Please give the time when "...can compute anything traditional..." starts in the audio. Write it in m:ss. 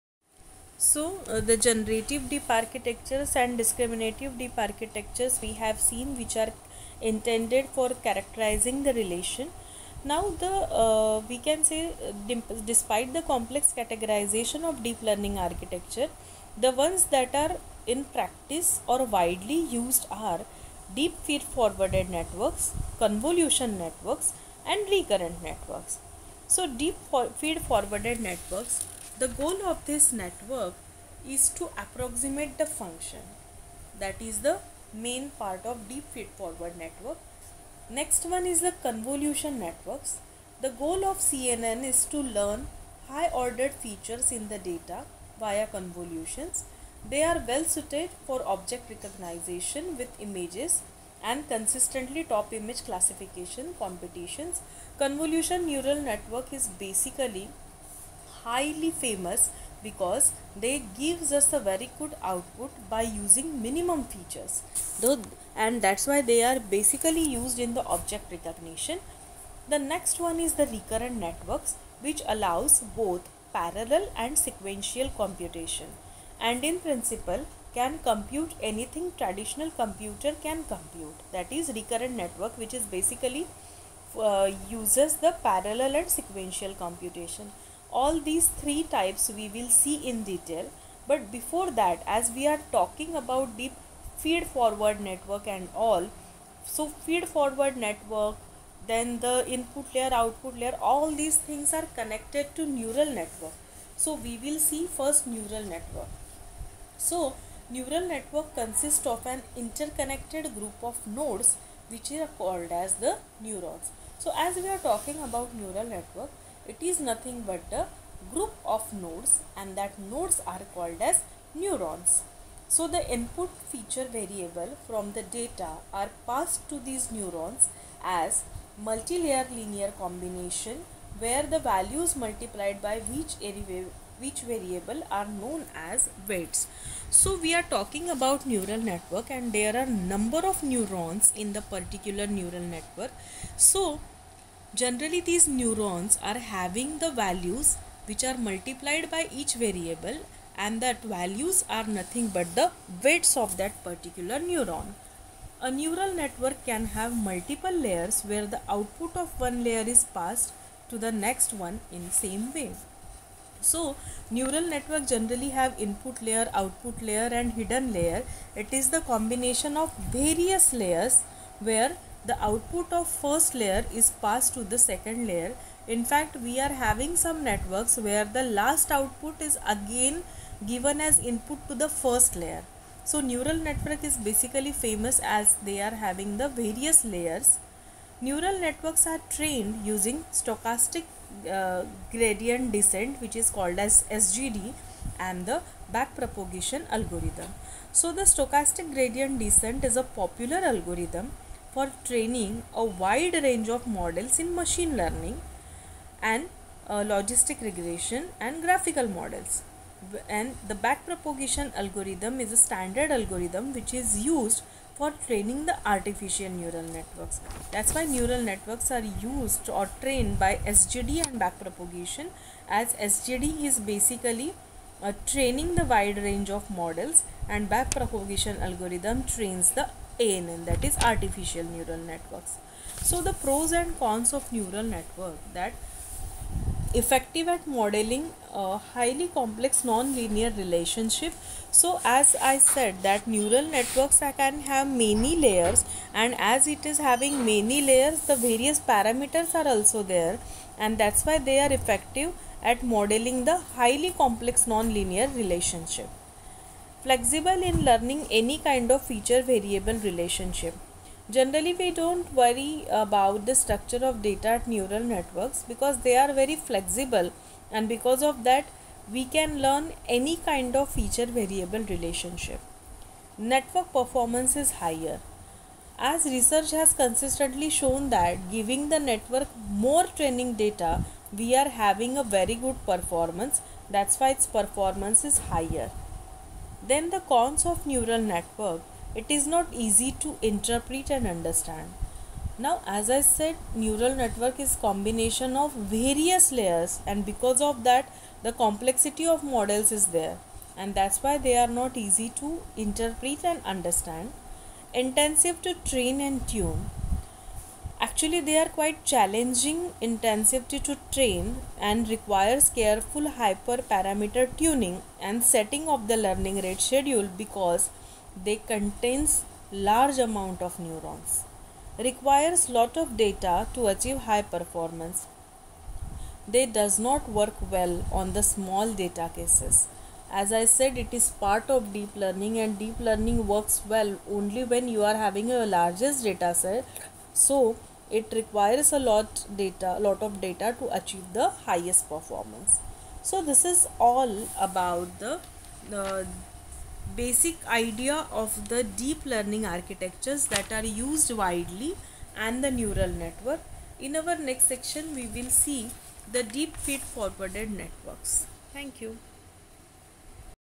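1:17.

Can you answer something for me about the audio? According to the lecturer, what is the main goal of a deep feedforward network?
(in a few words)
approximate the function.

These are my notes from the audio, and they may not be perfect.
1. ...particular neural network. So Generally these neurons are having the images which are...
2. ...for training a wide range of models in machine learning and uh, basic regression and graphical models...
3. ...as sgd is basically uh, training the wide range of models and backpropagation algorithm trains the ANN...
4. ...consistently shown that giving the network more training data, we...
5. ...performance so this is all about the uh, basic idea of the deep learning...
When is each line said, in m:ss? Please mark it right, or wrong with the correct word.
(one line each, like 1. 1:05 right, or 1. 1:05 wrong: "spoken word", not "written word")
1. 2:21 wrong: "values", not "images"
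2. 3:21 wrong: "logistic", not "basic"
3. 3:42 right
4. 4:36 right
5. 5:42 right.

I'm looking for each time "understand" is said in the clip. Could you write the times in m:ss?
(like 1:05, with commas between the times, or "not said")
4:51, 5:03.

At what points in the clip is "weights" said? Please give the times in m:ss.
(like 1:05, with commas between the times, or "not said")
2:16, 2:33.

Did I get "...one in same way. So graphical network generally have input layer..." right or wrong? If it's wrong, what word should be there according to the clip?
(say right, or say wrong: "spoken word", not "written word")
wrong: "neural", not "graphical".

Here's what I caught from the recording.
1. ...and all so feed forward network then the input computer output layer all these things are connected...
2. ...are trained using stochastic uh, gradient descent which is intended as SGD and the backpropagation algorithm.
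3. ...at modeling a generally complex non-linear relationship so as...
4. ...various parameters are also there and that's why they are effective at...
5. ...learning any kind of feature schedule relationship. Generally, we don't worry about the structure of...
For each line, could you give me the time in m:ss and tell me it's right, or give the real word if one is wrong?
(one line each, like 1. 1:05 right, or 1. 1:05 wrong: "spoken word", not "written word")
1. 1:35 wrong: "layer", not "computer"
2. 3:09 wrong: "called", not "intended"
3. 3:57 wrong: "highly", not "generally"
4. 4:08 right
5. 4:17 wrong: "variable", not "schedule".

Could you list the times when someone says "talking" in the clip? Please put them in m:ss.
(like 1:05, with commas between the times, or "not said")
1:32, 1:54, 2:17.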